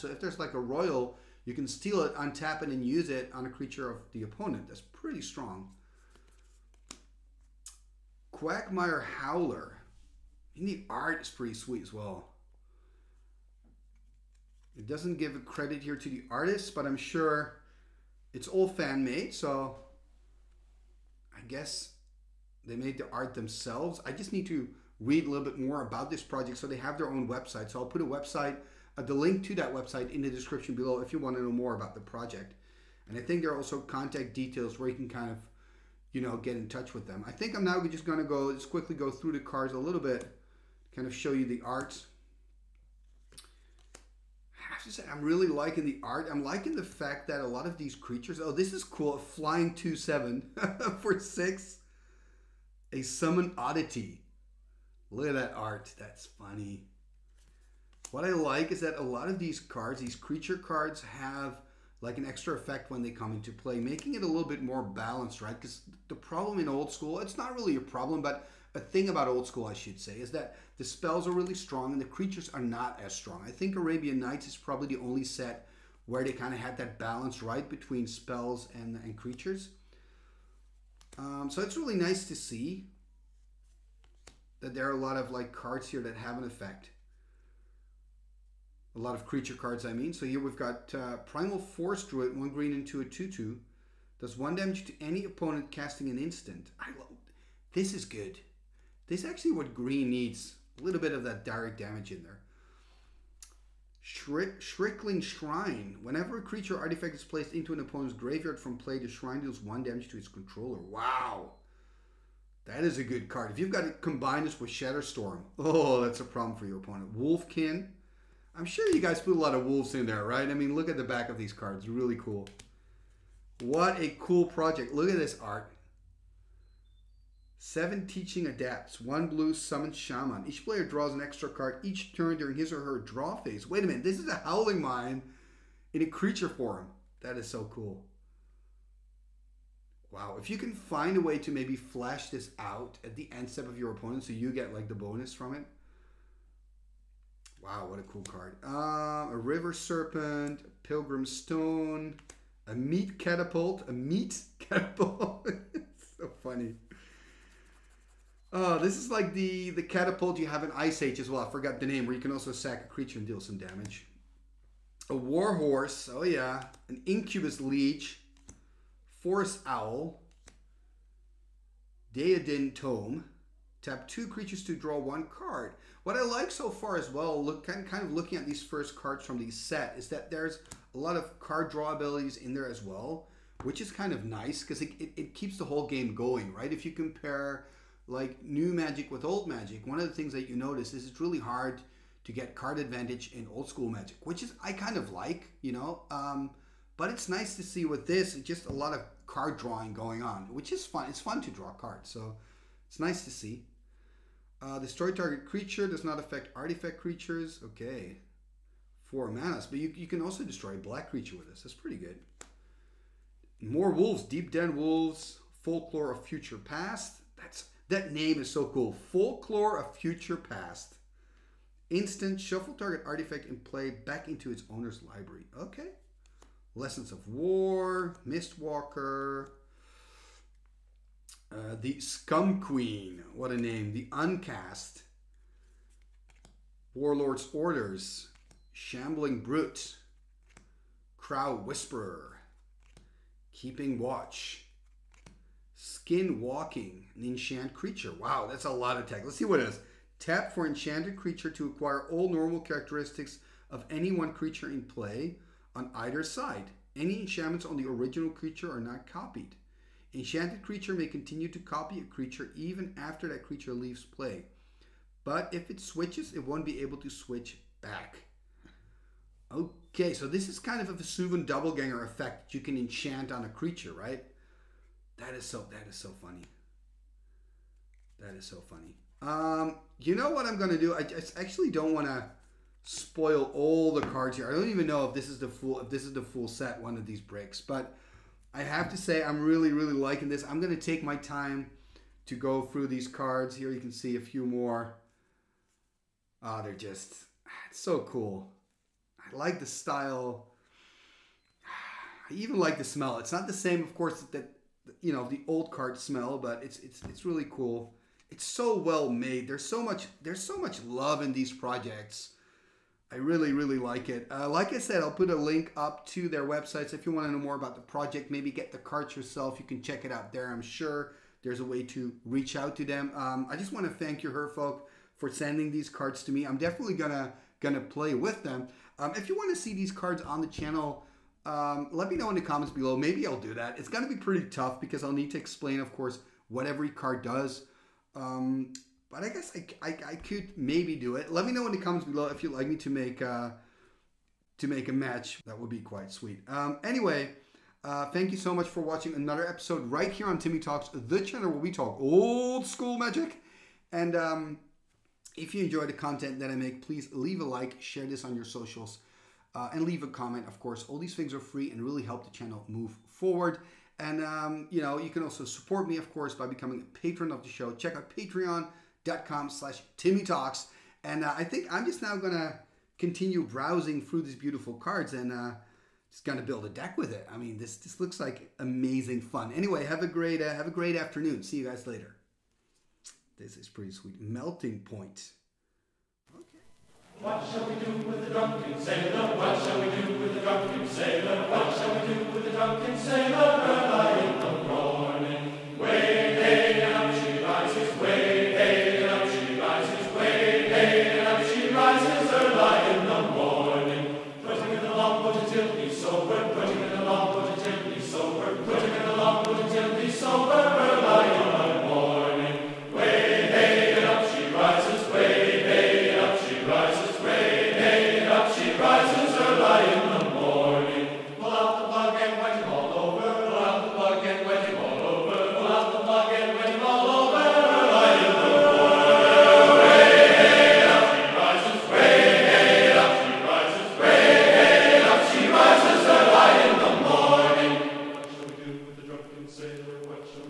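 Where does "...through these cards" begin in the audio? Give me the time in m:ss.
4:52.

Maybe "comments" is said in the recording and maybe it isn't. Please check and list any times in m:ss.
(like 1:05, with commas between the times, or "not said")
5:32, 5:41, 6:00.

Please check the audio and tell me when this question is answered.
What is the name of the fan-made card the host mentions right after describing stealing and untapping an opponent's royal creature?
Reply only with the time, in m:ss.
0:08.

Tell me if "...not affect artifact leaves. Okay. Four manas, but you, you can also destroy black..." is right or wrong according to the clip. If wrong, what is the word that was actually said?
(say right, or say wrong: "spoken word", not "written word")
wrong: "creatures", not "leaves".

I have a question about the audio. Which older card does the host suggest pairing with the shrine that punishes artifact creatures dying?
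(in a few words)
Shatterstorm.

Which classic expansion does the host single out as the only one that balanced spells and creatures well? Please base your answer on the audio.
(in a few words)
Arabian Nights.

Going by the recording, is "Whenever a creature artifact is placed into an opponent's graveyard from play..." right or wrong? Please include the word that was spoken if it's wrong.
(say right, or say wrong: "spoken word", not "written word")
right.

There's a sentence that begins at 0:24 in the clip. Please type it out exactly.
I just need to read a little bit more about this project so they have their own website.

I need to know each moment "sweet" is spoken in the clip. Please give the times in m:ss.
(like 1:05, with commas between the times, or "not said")
0:11, 5:46, 6:23.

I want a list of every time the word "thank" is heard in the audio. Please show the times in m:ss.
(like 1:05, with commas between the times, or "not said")
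5:24, 5:48.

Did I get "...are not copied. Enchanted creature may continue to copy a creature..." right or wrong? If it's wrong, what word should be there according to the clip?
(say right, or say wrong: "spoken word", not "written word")
right.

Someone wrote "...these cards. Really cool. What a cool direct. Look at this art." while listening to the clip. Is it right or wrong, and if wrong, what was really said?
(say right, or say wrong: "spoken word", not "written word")
wrong: "project", not "direct".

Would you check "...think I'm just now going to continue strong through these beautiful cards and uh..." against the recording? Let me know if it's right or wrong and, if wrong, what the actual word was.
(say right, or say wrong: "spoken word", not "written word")
wrong: "browsing", not "strong".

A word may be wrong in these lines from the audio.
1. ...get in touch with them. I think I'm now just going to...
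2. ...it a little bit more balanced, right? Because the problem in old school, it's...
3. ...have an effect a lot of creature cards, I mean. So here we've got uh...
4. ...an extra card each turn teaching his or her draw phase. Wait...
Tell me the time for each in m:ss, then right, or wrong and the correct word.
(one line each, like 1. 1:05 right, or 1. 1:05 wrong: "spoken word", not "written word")
1. 0:36 right
2. 1:04 right
3. 1:26 right
4. 2:11 wrong: "during", not "teaching".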